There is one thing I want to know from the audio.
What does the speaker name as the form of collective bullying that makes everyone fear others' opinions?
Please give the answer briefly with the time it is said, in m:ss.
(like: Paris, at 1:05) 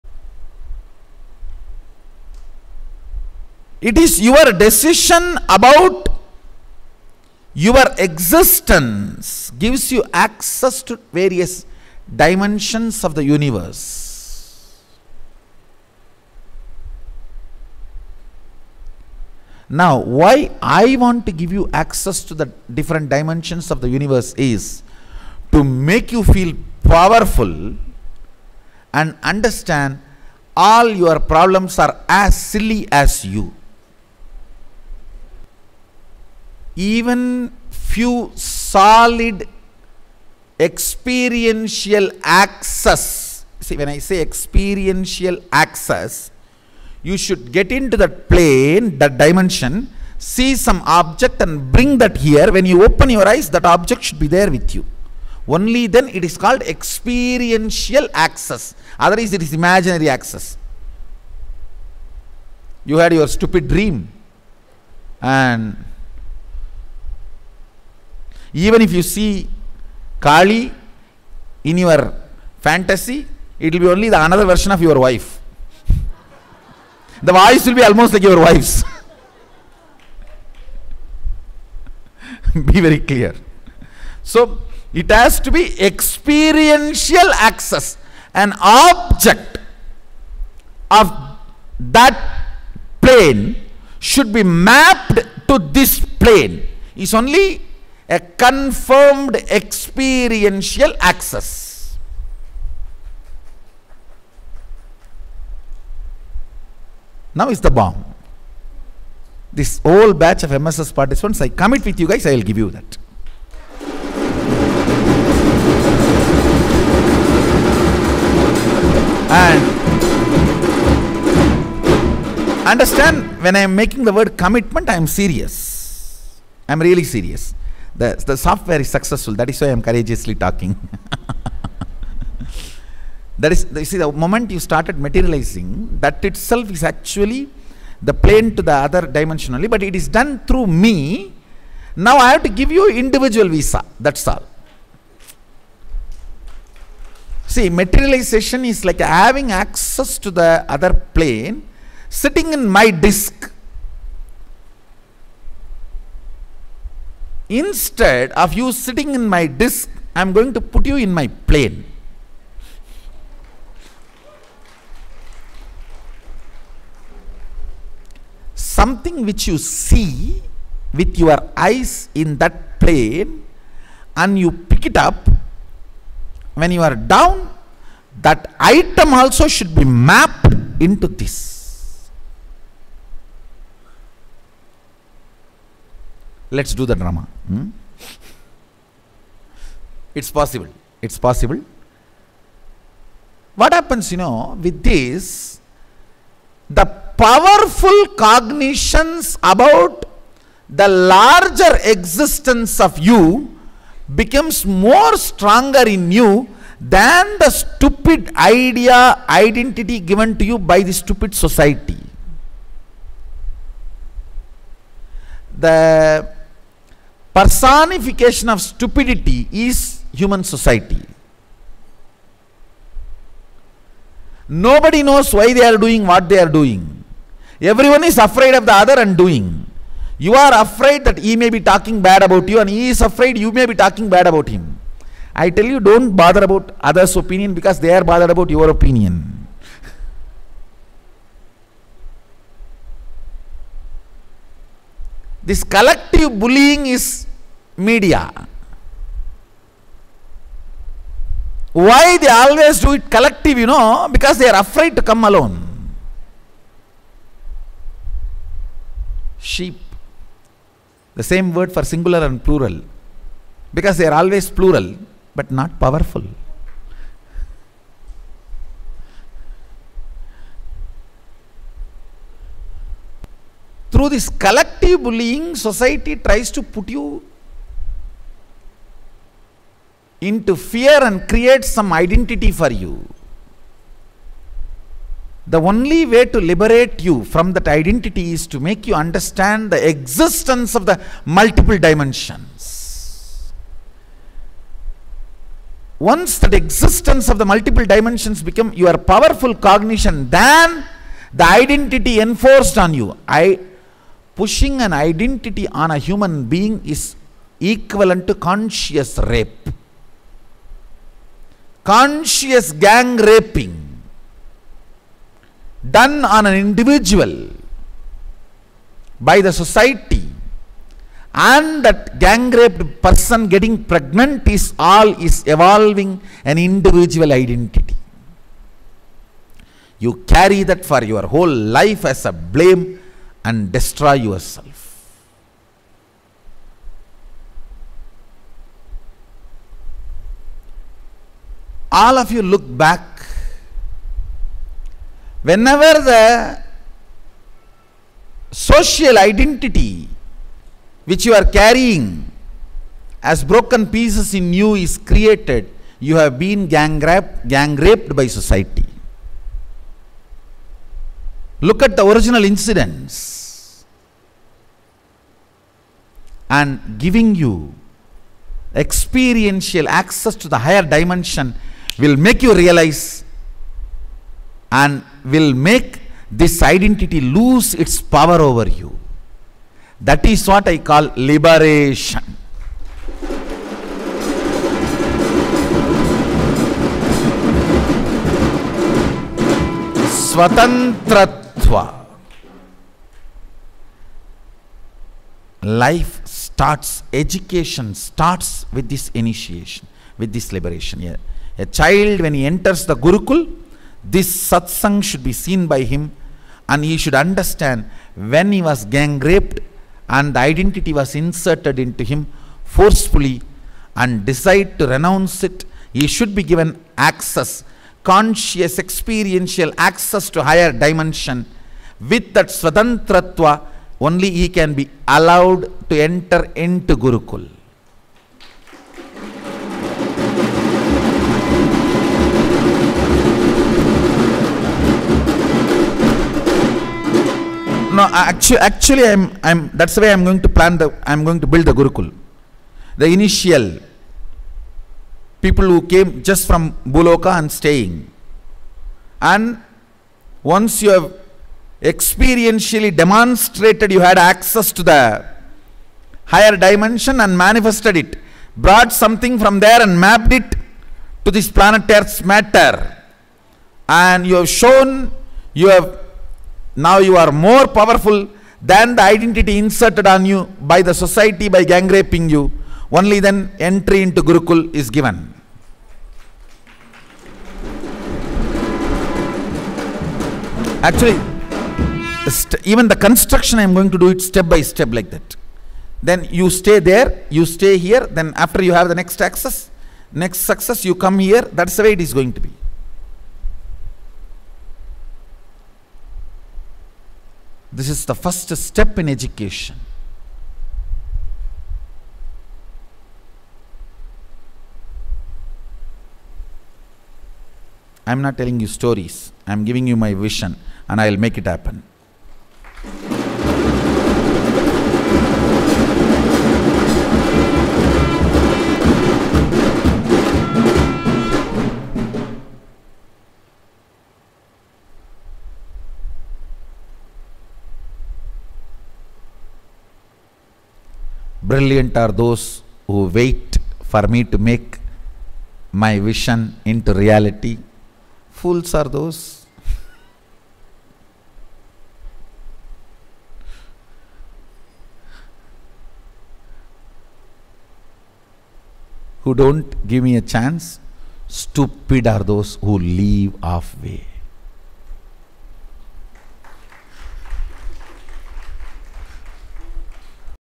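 media, at 4:07.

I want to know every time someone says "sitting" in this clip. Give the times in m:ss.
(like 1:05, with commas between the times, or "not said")
2:32, 2:38.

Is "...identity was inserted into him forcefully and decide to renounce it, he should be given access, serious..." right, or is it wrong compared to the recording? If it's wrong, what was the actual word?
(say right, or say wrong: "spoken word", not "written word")
wrong: "conscious", not "serious".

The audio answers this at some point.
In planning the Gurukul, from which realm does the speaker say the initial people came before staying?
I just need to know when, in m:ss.
7:26.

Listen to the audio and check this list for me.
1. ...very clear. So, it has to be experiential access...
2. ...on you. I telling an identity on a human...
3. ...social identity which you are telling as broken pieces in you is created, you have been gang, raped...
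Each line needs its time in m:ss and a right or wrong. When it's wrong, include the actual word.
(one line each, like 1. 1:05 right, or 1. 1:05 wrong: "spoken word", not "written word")
1. 1:22 right
2. 5:02 wrong: "pushing", not "telling"
3. 5:48 wrong: "carrying", not "telling".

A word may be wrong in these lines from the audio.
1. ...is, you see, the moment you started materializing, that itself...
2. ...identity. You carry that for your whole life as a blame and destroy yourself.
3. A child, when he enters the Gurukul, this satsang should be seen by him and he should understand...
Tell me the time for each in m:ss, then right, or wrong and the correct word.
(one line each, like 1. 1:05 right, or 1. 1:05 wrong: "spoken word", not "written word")
1. 2:13 right
2. 5:27 right
3. 6:41 right.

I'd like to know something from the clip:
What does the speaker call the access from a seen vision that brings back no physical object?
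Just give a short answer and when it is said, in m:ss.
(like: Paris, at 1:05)
imaginary access, at 0:59.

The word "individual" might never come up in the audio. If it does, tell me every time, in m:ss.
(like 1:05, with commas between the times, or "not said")
2:22, 5:16, 5:26.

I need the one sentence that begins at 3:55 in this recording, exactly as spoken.
I tell you, don't bother about others' opinion because they are bothered about your opinion.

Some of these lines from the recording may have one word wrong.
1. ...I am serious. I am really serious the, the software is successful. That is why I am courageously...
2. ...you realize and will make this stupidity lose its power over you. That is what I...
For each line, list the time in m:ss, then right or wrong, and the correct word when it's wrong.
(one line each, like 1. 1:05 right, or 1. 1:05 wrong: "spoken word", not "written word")
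1. 2:04 right
2. 6:12 wrong: "identity", not "stupidity".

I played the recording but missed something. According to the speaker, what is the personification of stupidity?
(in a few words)
human society.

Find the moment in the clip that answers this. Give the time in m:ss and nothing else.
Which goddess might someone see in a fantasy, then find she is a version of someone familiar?
1:10.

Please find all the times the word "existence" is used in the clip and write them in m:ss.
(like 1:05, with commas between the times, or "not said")
0:07, 3:21, 4:49, 4:56.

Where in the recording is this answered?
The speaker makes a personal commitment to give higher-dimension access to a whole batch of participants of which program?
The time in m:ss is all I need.
1:50.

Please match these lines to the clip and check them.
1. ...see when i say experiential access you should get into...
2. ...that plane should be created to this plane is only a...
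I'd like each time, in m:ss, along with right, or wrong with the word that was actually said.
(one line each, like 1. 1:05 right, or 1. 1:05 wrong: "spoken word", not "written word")
1. 0:43 right
2. 1:31 wrong: "mapped", not "created".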